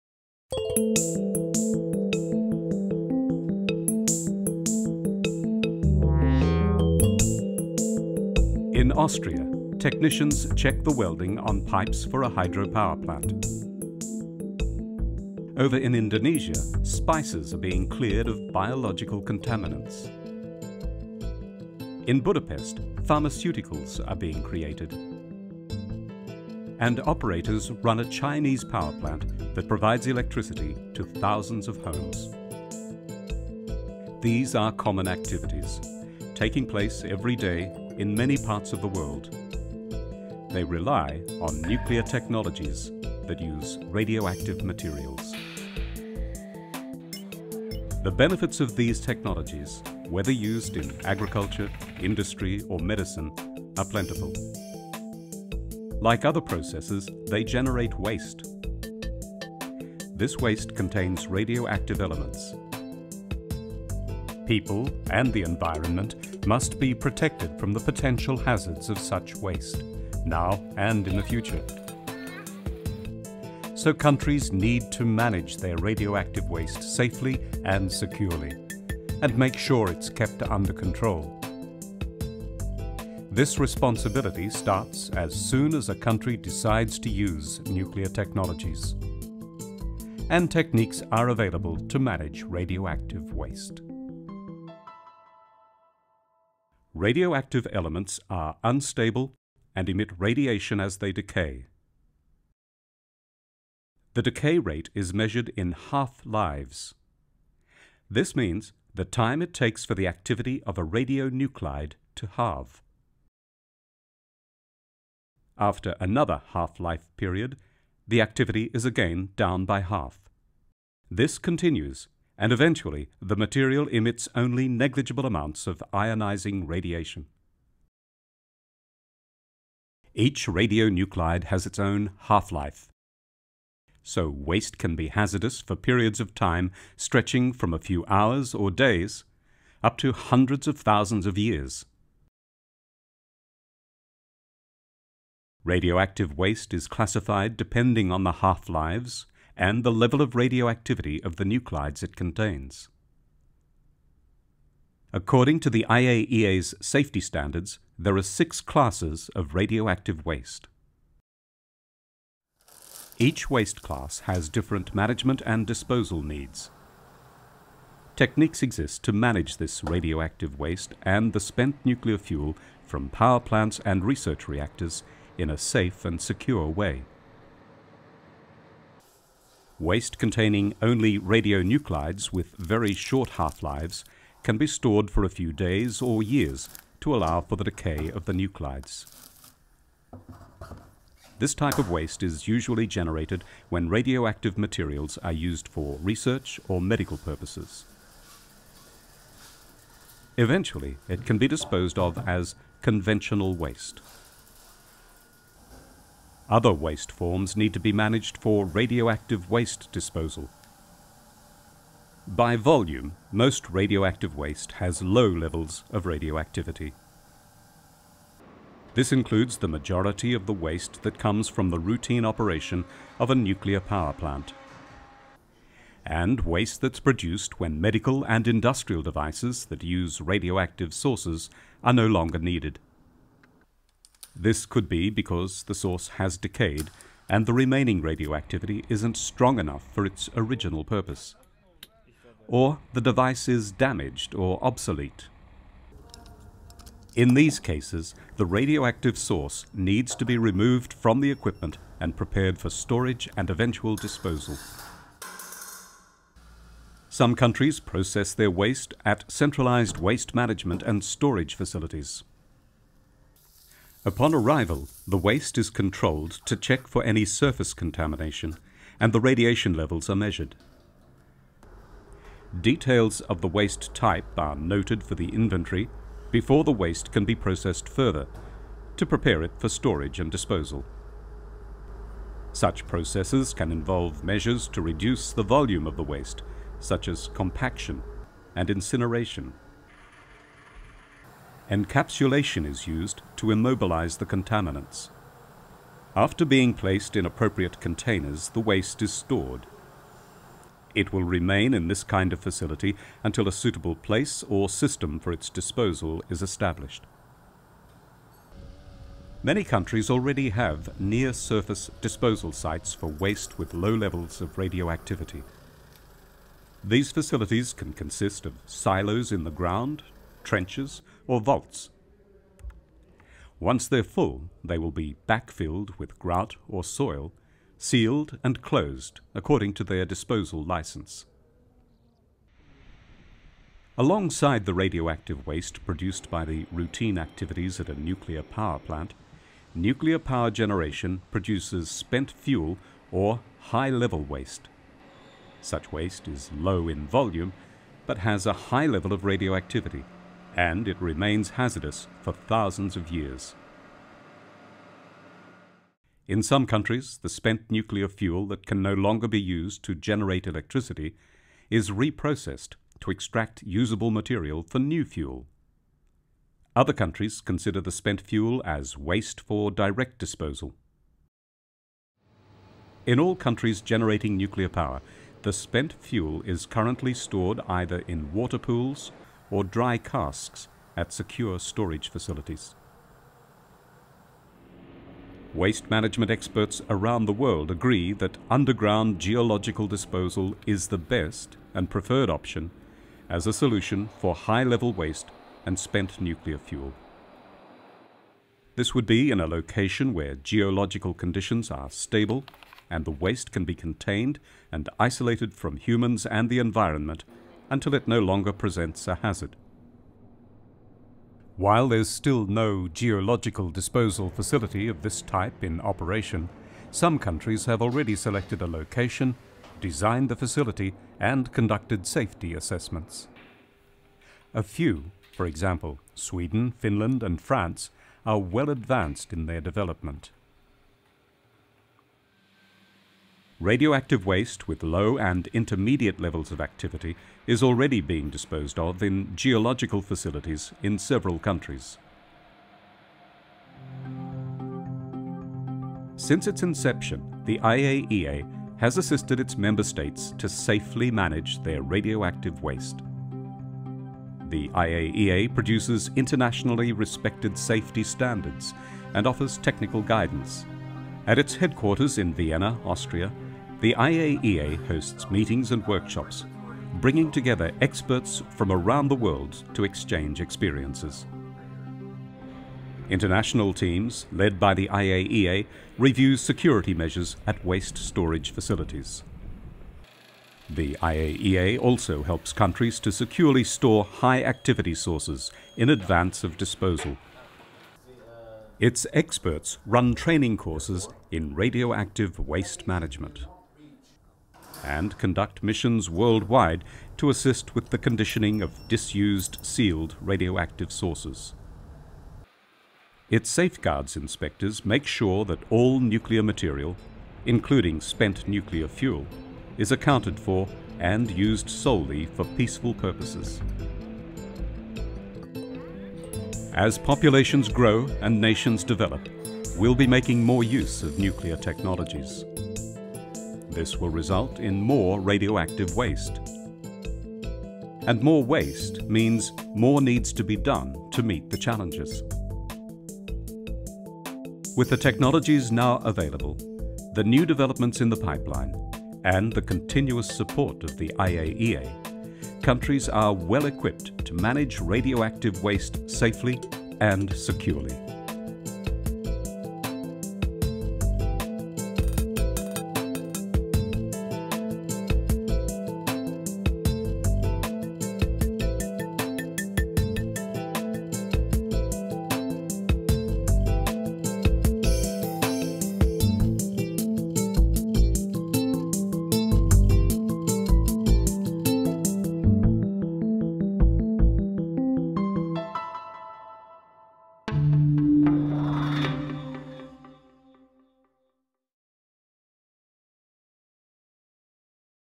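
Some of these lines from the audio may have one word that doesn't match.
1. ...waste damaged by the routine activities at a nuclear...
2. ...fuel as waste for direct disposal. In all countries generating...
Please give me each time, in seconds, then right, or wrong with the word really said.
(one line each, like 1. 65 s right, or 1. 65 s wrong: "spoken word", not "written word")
1. 335 s wrong: "produced", not "damaged"
2. 368 s right.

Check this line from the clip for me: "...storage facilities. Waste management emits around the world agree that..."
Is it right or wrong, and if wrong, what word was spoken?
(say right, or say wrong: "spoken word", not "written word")
wrong: "experts", not "emits".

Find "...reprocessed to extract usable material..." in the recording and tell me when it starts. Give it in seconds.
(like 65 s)
361 s.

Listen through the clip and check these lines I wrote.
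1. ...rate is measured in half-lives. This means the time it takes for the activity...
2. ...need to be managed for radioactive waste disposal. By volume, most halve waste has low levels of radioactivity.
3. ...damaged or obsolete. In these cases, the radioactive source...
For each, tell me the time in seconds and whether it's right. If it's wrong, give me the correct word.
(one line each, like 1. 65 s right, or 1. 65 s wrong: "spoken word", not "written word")
1. 104 s right
2. 207 s wrong: "radioactive", not "halve"
3. 243 s right.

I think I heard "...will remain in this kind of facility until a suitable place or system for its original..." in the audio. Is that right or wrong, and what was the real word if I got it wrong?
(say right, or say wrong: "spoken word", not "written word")
wrong: "disposal", not "original".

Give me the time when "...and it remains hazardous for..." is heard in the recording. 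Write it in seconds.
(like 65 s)
350 s.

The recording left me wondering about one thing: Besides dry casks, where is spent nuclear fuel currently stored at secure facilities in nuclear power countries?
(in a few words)
water pools.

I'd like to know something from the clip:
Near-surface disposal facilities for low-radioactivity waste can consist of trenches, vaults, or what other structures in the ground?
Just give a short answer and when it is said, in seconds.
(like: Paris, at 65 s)
silos, at 318 s.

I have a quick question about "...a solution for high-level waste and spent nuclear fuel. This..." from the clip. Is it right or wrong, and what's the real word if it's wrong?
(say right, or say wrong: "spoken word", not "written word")
right.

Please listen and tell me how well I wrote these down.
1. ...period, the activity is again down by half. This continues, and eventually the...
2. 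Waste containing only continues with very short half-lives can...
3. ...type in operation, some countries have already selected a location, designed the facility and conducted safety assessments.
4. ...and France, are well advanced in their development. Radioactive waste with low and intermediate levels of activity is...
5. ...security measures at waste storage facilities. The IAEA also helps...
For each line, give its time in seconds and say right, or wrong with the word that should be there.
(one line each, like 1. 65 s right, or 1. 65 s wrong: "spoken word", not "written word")
1. 117 s right
2. 179 s wrong: "radionuclides", not "continues"
3. 415 s right
4. 427 s right
5. 476 s right.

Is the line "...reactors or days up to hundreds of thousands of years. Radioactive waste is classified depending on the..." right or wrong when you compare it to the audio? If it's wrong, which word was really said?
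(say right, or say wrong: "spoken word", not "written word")
wrong: "hours", not "reactors".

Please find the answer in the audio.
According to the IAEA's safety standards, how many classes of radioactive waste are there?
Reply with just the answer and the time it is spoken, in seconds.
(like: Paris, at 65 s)
6, at 158 s.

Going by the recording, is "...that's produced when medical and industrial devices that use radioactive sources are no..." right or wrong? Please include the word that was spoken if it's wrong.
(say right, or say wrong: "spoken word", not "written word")
right.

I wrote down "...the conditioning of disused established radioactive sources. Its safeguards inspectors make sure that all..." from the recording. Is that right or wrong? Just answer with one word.
wrong.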